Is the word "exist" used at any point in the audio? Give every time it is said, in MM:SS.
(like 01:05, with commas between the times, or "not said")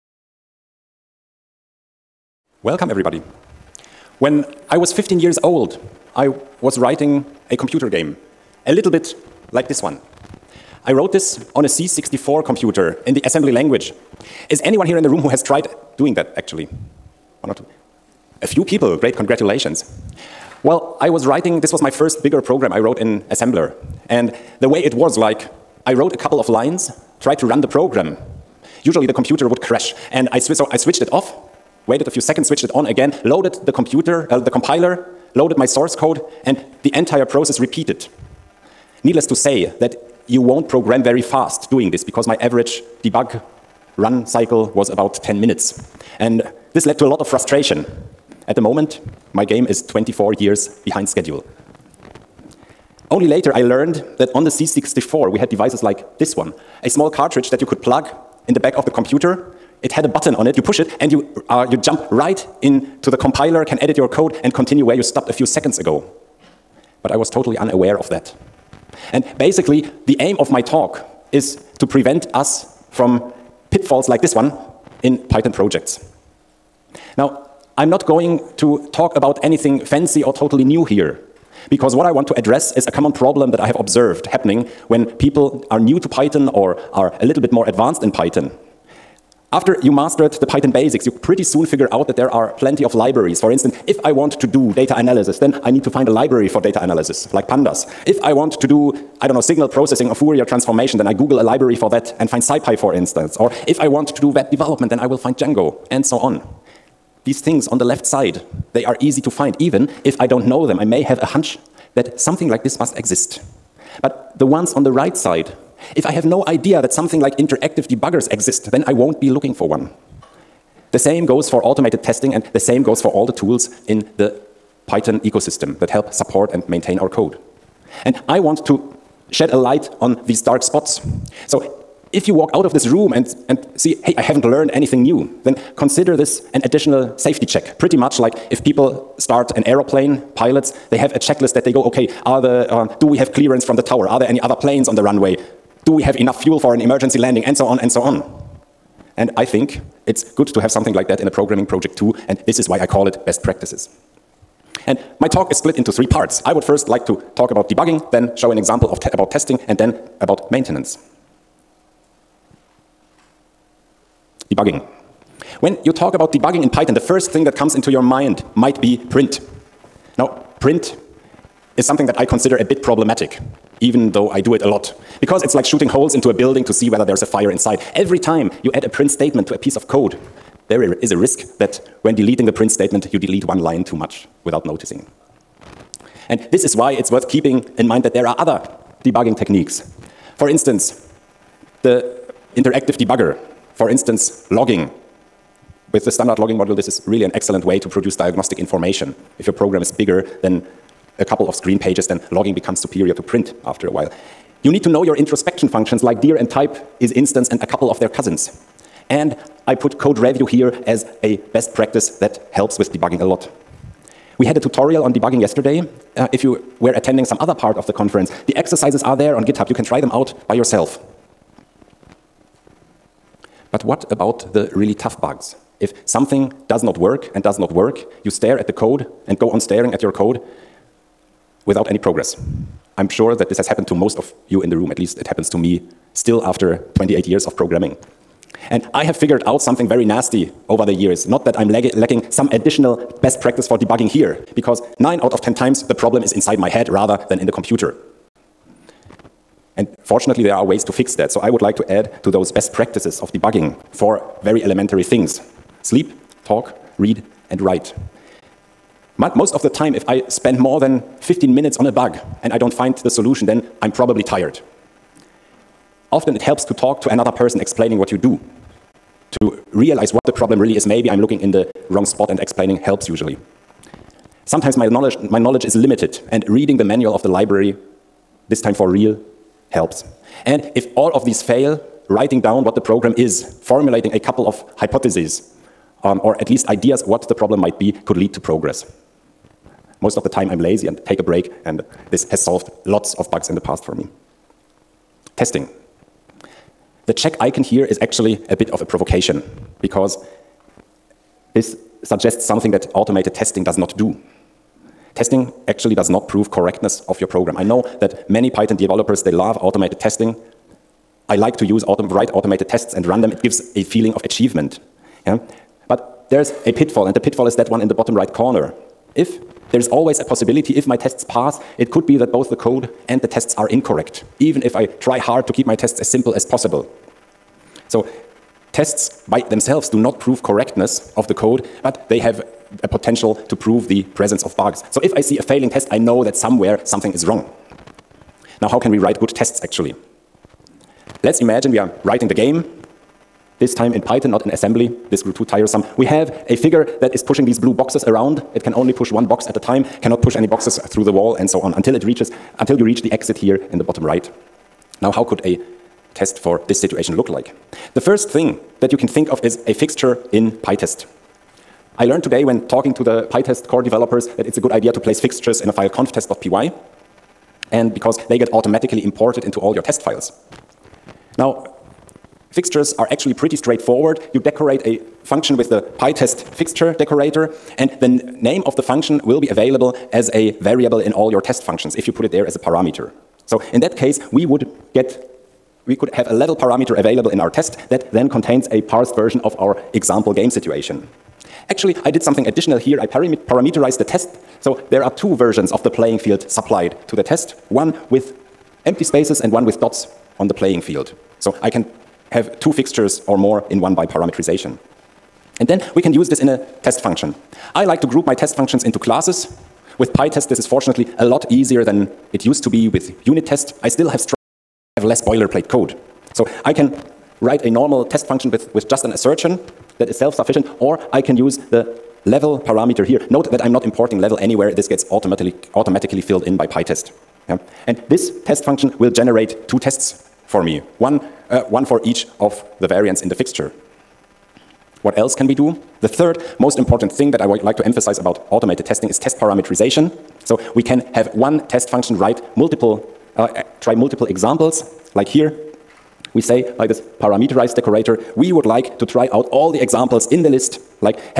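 01:52, 01:58.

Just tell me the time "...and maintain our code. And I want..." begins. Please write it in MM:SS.
02:06.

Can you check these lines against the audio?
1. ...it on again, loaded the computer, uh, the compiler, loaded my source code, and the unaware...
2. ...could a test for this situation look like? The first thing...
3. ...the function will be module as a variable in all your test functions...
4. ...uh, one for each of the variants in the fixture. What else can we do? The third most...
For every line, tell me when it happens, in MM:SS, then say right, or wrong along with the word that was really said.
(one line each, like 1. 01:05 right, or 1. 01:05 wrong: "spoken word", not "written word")
1. 00:32 wrong: "entire", not "unaware"
2. 05:55 right
3. 06:18 wrong: "available", not "module"
4. 07:11 right.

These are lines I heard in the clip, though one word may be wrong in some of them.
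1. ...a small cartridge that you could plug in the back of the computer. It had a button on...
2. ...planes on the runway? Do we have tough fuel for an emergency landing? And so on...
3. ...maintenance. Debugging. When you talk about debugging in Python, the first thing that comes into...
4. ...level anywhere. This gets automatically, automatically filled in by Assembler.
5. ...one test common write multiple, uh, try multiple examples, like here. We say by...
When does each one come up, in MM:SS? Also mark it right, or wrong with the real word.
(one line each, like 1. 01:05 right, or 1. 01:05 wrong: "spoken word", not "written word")
1. 00:56 right
2. 02:24 wrong: "enough", not "tough"
3. 02:40 right
4. 07:04 wrong: "PyTest", not "Assembler"
5. 07:21 wrong: "function", not "common".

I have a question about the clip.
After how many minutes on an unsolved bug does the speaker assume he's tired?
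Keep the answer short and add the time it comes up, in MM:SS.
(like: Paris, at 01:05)
15 minutes, at 04:21.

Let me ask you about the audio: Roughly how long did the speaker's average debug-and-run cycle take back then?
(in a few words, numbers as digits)
10 minutes.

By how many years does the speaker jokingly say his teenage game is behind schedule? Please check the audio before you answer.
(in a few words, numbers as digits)
24.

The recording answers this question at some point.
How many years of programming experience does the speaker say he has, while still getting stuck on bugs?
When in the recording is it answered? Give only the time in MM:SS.
03:56.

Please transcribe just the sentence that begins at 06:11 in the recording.
Now, fixtures are actually pretty straightforward.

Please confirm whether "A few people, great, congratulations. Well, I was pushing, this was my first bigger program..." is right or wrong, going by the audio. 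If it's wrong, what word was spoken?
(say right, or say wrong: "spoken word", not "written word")
wrong: "writing", not "pushing".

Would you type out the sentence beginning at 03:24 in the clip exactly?
You need to know your introspection functions like dir and type isinstance and a couple of their cousins.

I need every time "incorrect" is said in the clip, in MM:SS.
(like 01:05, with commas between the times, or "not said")
05:23.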